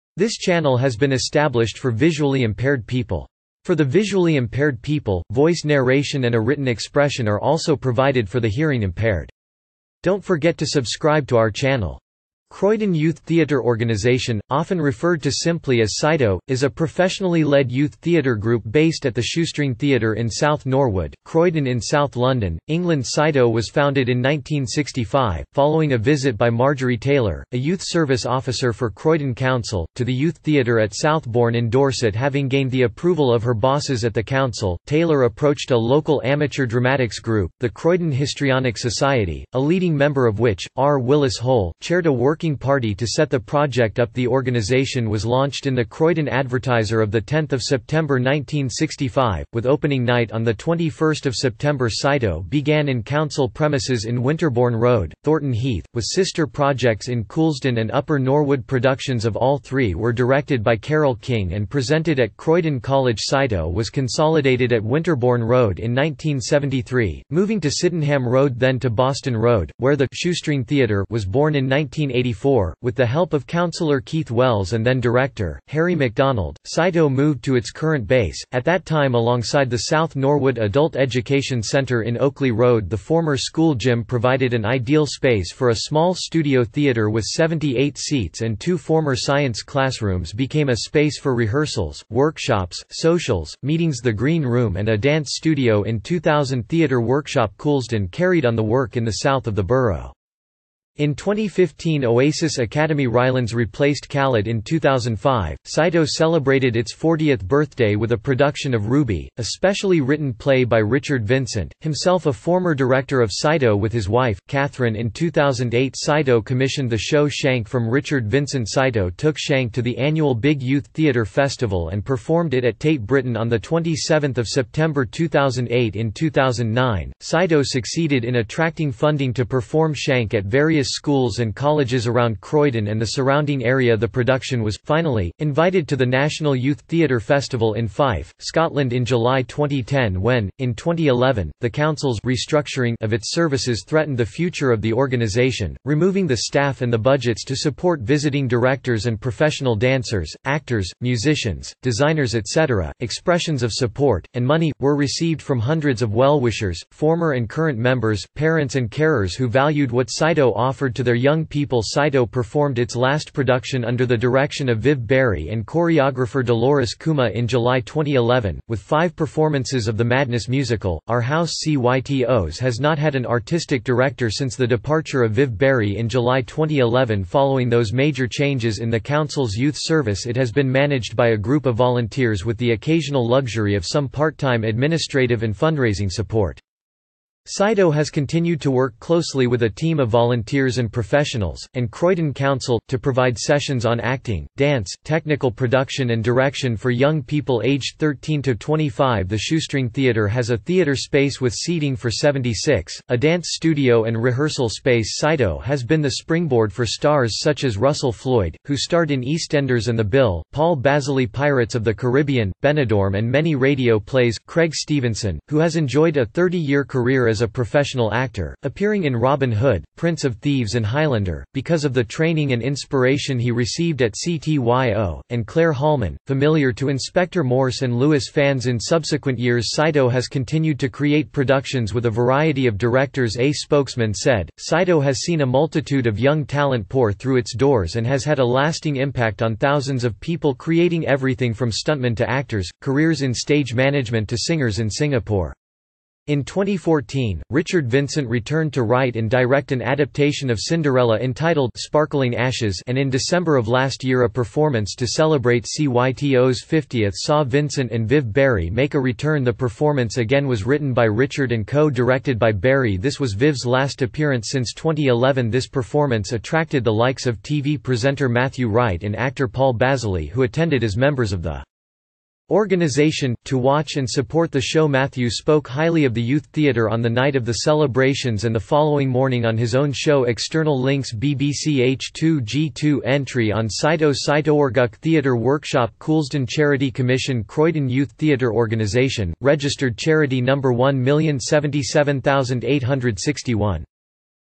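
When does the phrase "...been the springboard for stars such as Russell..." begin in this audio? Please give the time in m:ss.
3:25.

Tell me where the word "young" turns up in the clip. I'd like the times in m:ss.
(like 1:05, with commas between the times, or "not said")
2:41, 3:16, 3:56.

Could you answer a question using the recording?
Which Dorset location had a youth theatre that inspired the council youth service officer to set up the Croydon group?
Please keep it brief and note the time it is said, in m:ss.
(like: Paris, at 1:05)
Southbourne, at 0:30.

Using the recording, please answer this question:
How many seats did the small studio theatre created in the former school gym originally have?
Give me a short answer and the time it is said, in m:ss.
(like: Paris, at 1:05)
78, at 1:27.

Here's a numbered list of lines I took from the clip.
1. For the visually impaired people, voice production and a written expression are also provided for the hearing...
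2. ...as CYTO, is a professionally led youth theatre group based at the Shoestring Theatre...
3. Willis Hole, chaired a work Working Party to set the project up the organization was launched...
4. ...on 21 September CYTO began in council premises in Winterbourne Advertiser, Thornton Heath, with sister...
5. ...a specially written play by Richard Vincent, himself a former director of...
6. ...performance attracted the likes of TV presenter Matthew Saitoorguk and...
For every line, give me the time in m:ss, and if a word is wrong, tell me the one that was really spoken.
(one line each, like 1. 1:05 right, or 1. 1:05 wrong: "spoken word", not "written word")
1. 0:03 wrong: "narration", not "production"
2. 0:15 right
3. 0:40 right
4. 0:50 wrong: "Road", not "Advertiser"
5. 1:49 right
6. 4:25 wrong: "Wright", not "Saitoorguk".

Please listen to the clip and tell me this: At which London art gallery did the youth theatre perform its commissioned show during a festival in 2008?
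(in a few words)
Tate Britain.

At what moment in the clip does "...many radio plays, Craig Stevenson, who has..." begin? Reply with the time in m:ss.
3:33.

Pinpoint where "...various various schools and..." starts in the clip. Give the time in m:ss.
2:10.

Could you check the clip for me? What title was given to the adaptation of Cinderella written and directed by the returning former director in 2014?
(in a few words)
Sparkling Ashes.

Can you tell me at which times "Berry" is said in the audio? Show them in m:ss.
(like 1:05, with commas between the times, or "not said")
2:45, 2:55.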